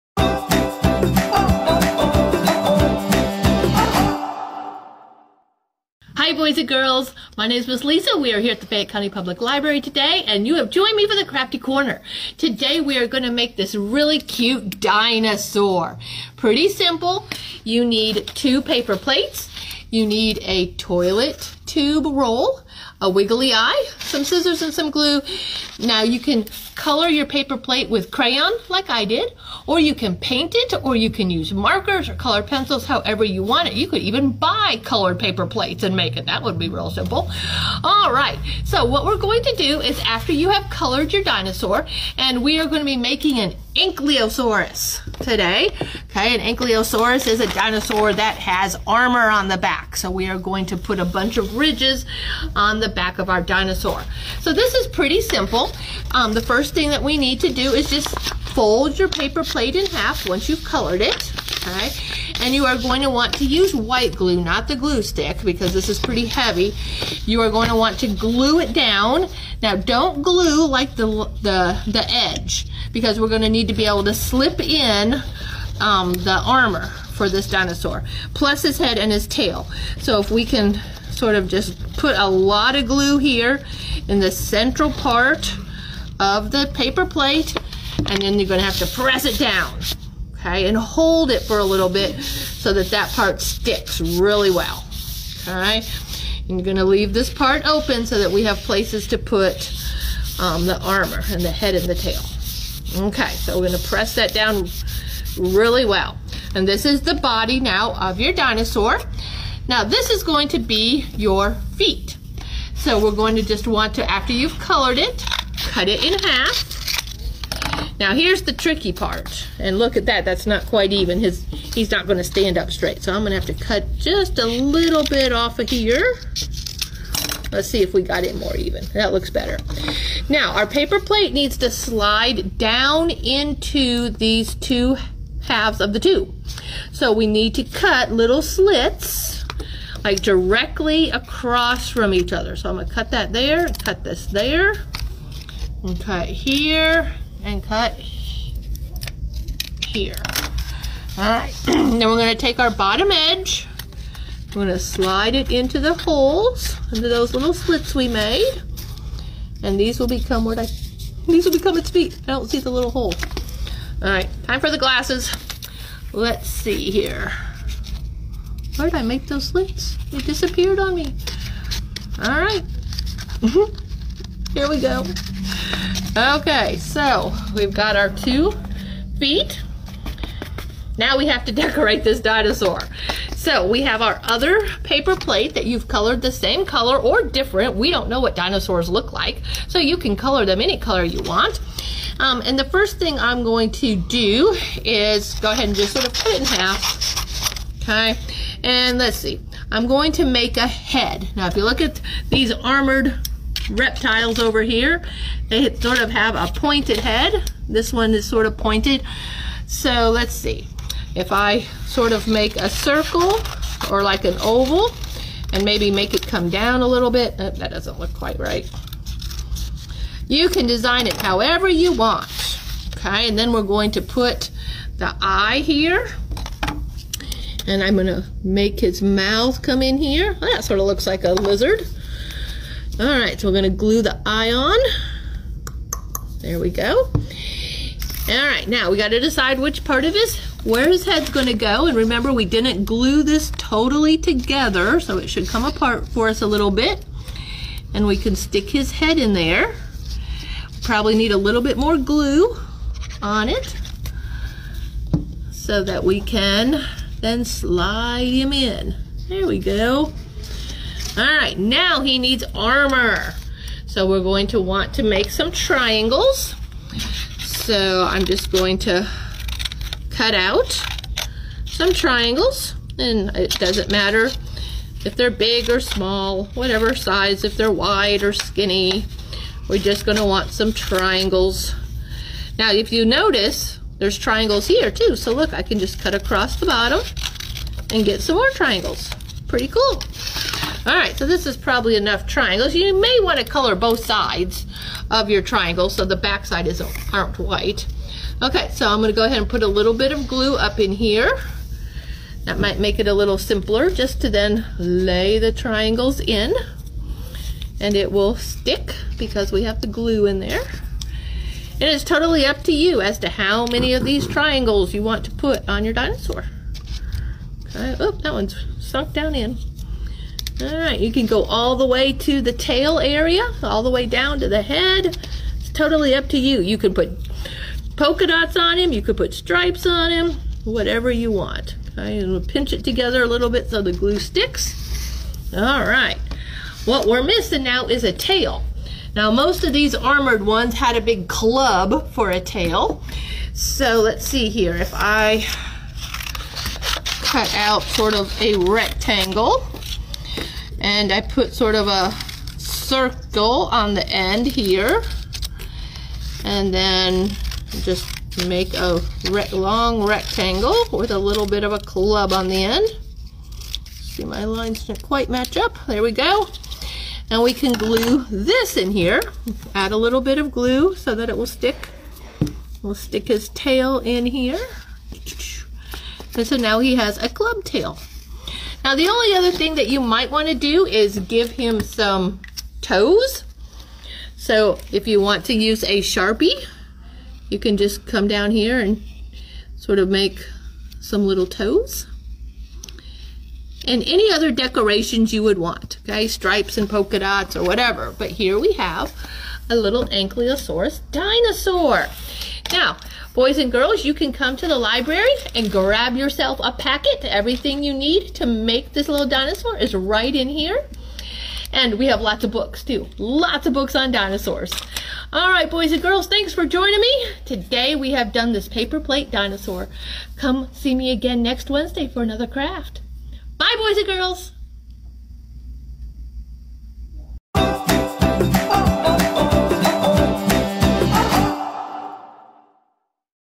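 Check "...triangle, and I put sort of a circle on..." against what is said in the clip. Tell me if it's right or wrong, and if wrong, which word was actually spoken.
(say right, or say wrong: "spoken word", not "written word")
wrong: "rectangle", not "triangle".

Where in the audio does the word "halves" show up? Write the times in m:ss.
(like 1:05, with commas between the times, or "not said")
2:15.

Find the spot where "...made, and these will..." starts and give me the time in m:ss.
2:38.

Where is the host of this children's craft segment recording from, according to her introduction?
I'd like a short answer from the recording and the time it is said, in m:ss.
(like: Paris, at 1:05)
Fayette County Public Library, at 0:08.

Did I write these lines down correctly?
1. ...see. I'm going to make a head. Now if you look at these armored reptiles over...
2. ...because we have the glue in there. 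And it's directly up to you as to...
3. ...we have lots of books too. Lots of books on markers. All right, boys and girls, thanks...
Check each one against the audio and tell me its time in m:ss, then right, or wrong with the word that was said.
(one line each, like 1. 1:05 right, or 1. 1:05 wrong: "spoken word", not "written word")
1. 3:19 right
2. 5:09 wrong: "totally", not "directly"
3. 6:51 wrong: "dinosaurs", not "markers".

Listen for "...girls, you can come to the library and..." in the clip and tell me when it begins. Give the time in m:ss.
6:43.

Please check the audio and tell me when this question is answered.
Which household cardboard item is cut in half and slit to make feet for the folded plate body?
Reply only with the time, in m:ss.
0:20.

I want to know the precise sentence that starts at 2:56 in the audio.
Okay, so we've got our two feet.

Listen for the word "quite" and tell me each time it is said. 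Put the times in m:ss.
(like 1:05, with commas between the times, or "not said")
2:00, 3:38, 6:05.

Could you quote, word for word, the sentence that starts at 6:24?
So if you want to use a Sharpie, you can just come down here and sort of make some little toes.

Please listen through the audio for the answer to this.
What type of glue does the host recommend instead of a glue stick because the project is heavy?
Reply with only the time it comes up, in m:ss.
1:03.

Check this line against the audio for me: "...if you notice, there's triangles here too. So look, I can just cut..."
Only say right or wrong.
right.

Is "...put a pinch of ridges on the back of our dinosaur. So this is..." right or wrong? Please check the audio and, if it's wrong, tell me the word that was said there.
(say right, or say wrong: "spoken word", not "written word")
wrong: "bunch", not "pinch".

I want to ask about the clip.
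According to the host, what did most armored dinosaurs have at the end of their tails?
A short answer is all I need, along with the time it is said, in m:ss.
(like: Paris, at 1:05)
A big club, at 5:40.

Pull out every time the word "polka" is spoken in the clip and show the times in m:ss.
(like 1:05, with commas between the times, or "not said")
5:27, 6:36.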